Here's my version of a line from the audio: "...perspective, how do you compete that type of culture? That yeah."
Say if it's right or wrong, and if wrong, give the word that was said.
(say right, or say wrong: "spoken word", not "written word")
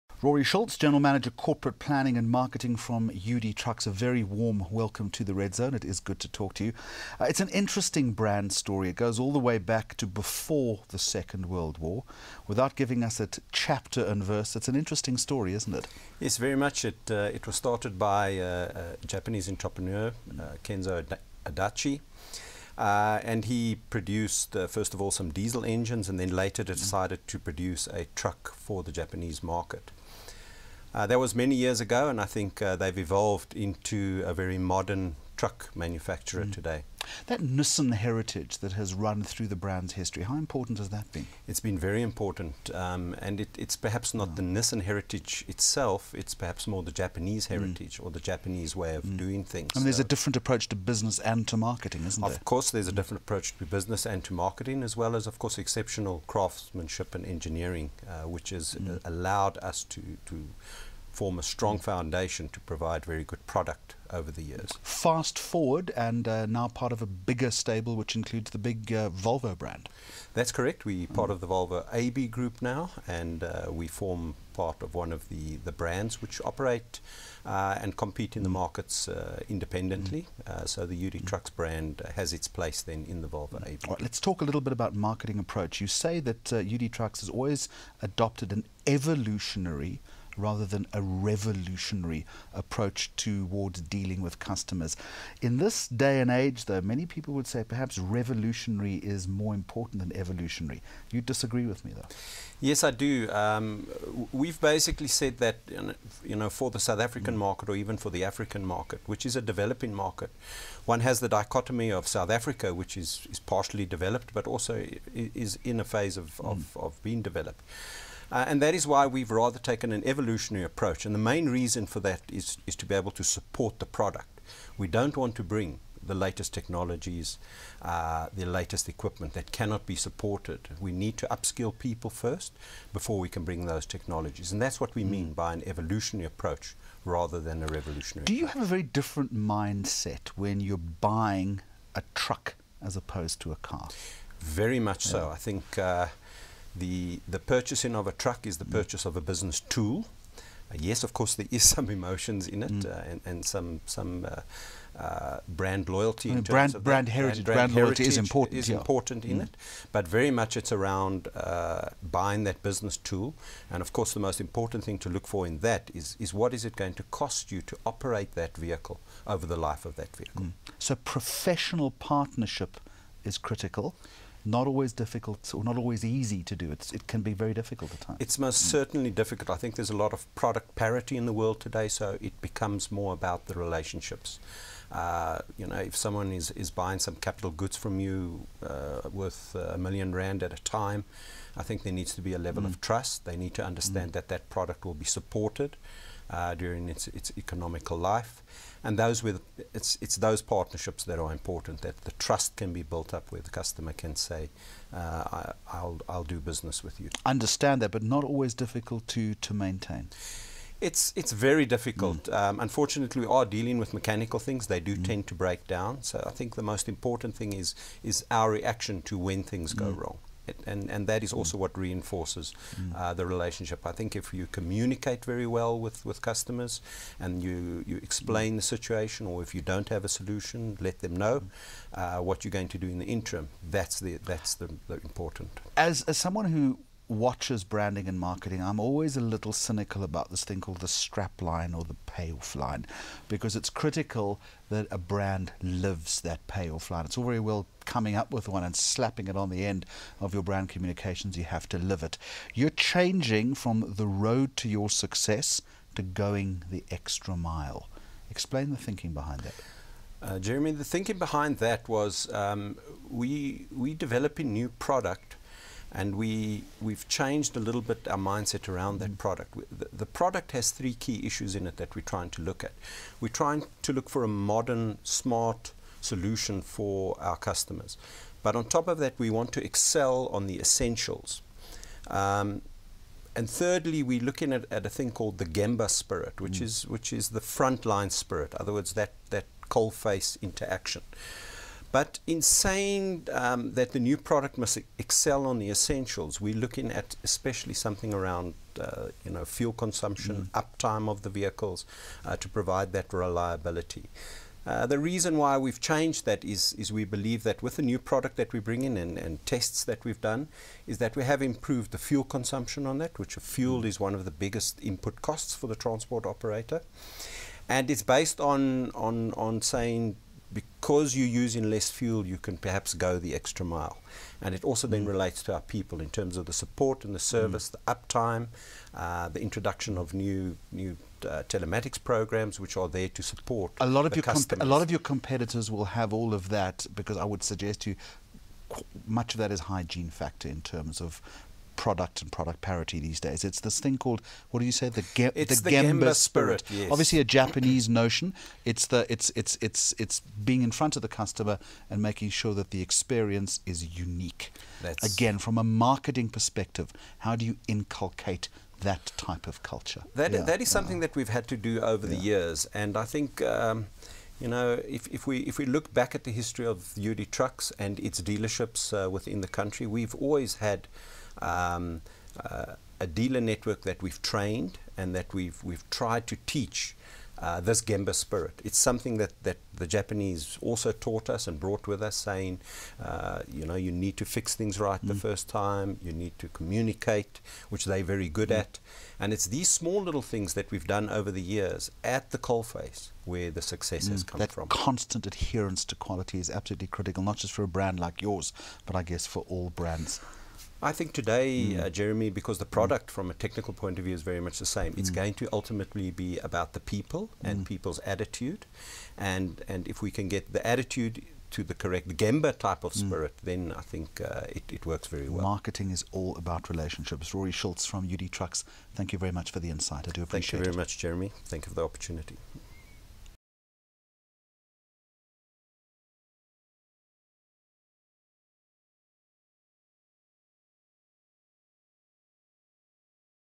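wrong: "inculcate", not "compete".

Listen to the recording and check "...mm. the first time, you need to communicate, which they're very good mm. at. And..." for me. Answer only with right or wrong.
right.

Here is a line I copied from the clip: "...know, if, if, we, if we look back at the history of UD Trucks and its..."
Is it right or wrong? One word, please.
right.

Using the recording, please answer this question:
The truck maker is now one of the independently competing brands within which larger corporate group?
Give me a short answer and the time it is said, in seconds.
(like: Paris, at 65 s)
Volvo AB group, at 71 s.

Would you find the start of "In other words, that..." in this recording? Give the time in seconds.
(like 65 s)
288 s.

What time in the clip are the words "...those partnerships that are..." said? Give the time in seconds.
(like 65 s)
200 s.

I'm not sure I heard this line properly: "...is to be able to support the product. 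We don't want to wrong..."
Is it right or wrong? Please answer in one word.
wrong.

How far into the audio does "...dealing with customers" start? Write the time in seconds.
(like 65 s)
93 s.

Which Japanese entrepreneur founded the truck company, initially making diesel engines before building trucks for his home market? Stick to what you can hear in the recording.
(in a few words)
Kenzo Adachi.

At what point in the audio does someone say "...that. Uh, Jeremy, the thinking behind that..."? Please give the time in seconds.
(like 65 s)
259 s.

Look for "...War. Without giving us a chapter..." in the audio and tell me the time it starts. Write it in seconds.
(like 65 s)
11 s.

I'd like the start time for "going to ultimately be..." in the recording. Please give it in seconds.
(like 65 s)
405 s.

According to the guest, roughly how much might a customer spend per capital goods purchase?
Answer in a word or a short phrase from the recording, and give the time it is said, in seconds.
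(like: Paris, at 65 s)
a million rand, at 189 s.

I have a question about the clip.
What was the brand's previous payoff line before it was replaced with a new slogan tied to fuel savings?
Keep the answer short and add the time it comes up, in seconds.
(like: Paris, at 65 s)
the road to your success, at 253 s.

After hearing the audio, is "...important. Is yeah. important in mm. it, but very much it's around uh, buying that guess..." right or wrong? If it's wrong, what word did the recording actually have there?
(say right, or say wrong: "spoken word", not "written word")
wrong: "business", not "guess".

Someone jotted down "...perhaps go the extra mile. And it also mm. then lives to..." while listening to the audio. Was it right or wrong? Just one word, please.
wrong.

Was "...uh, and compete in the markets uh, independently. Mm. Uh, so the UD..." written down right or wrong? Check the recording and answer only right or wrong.
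right.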